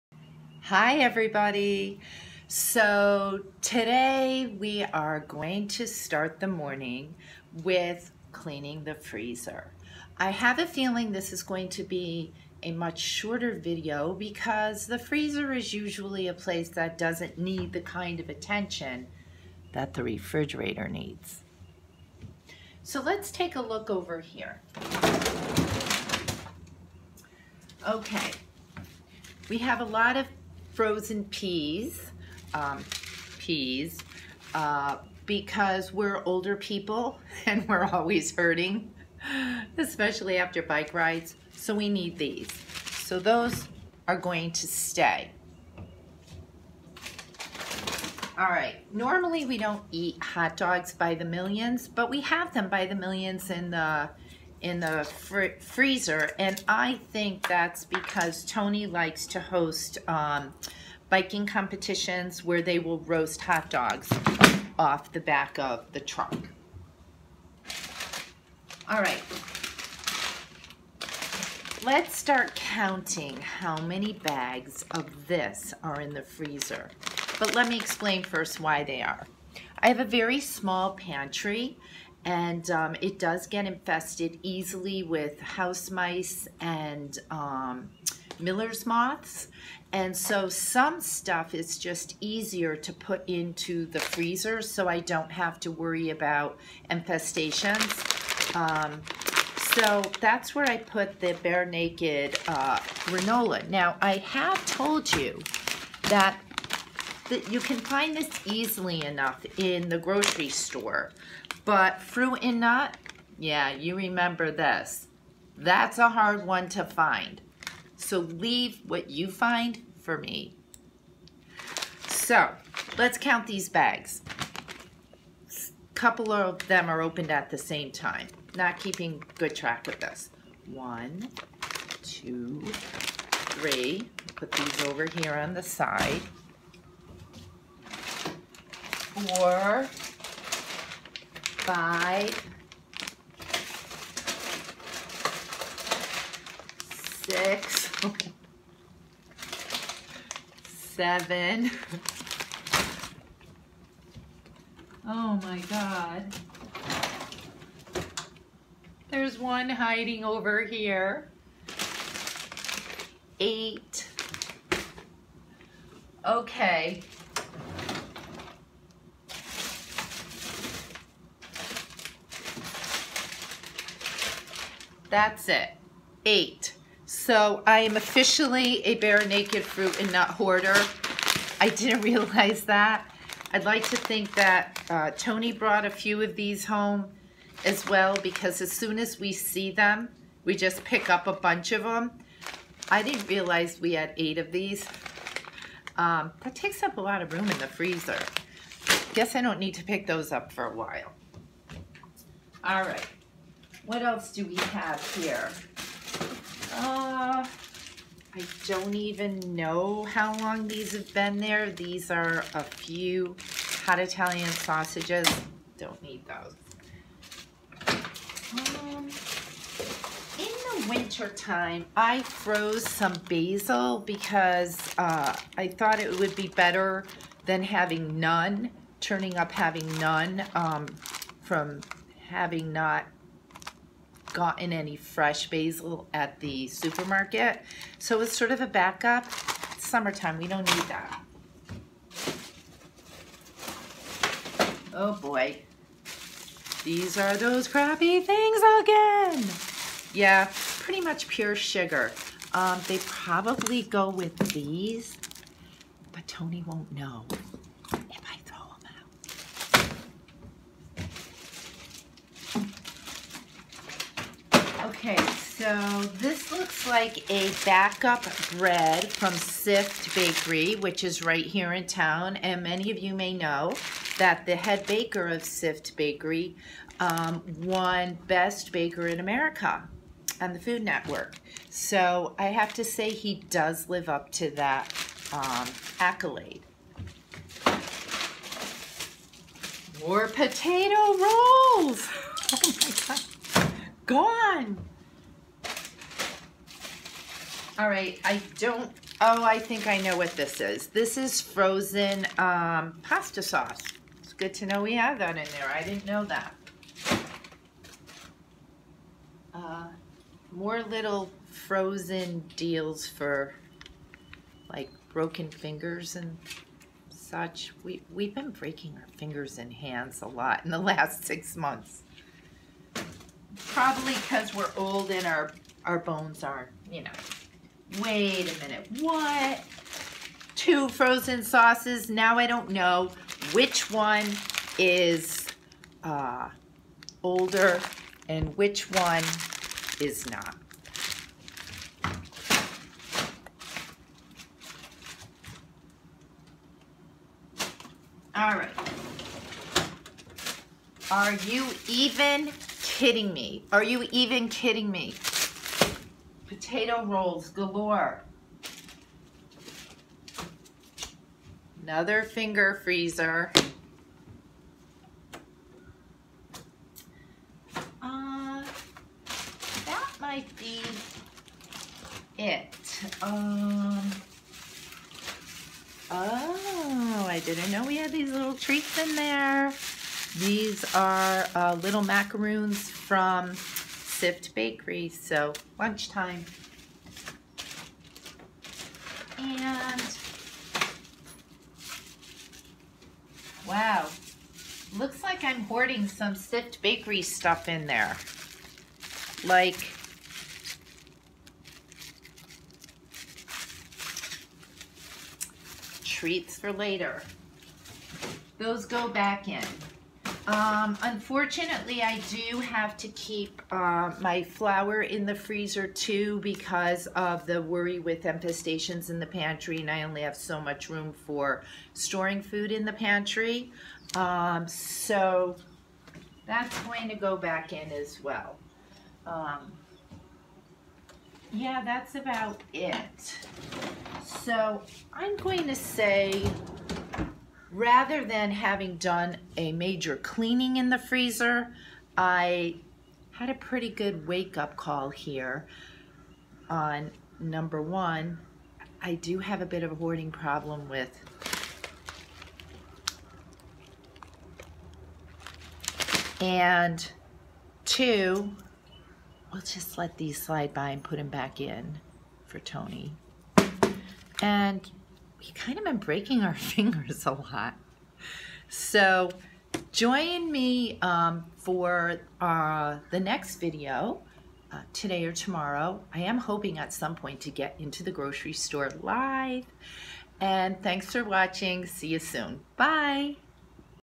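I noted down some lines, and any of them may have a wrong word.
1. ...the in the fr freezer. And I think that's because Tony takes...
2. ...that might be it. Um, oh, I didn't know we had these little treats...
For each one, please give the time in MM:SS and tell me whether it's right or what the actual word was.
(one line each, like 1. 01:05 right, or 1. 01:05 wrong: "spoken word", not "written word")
1. 00:53 wrong: "likes", not "takes"
2. 06:09 right.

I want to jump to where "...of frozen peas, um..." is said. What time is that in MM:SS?
00:30.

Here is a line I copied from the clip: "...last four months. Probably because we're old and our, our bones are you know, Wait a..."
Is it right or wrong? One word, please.
wrong.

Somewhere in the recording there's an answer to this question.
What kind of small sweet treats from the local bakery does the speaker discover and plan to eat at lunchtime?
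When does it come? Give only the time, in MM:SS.
06:22.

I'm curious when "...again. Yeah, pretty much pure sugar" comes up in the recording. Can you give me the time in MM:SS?
04:08.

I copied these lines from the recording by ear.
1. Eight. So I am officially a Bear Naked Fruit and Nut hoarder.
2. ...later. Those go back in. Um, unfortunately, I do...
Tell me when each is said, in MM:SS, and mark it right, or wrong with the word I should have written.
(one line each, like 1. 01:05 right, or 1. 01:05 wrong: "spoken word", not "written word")
1. 02:56 right
2. 06:46 right.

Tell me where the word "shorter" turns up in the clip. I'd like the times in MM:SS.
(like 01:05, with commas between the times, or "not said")
00:12.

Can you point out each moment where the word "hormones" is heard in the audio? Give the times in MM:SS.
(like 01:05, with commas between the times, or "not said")
not said.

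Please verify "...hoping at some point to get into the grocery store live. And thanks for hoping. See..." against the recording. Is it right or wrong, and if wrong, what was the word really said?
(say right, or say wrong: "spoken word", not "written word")
wrong: "watching", not "hoping".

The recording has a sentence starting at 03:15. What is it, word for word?
Um, that takes up a lot of room in the freezer.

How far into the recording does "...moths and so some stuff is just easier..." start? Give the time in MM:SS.
01:28.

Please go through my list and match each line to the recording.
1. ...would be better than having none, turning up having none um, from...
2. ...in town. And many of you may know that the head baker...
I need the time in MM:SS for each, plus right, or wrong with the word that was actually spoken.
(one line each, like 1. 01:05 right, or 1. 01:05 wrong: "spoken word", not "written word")
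1. 03:46 right
2. 04:31 right.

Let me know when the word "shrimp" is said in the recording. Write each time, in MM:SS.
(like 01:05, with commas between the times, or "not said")
not said.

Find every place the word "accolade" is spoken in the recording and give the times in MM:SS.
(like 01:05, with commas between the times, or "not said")
04:45.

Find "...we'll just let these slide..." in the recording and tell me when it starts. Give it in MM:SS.
07:39.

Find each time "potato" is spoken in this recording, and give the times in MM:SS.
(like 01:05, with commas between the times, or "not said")
04:50, 05:56.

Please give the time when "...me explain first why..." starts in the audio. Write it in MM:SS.
01:17.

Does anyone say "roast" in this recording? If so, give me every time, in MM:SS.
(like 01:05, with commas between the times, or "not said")
01:02.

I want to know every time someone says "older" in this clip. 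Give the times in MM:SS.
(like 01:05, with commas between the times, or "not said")
00:36, 05:37.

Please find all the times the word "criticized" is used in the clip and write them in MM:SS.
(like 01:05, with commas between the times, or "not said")
not said.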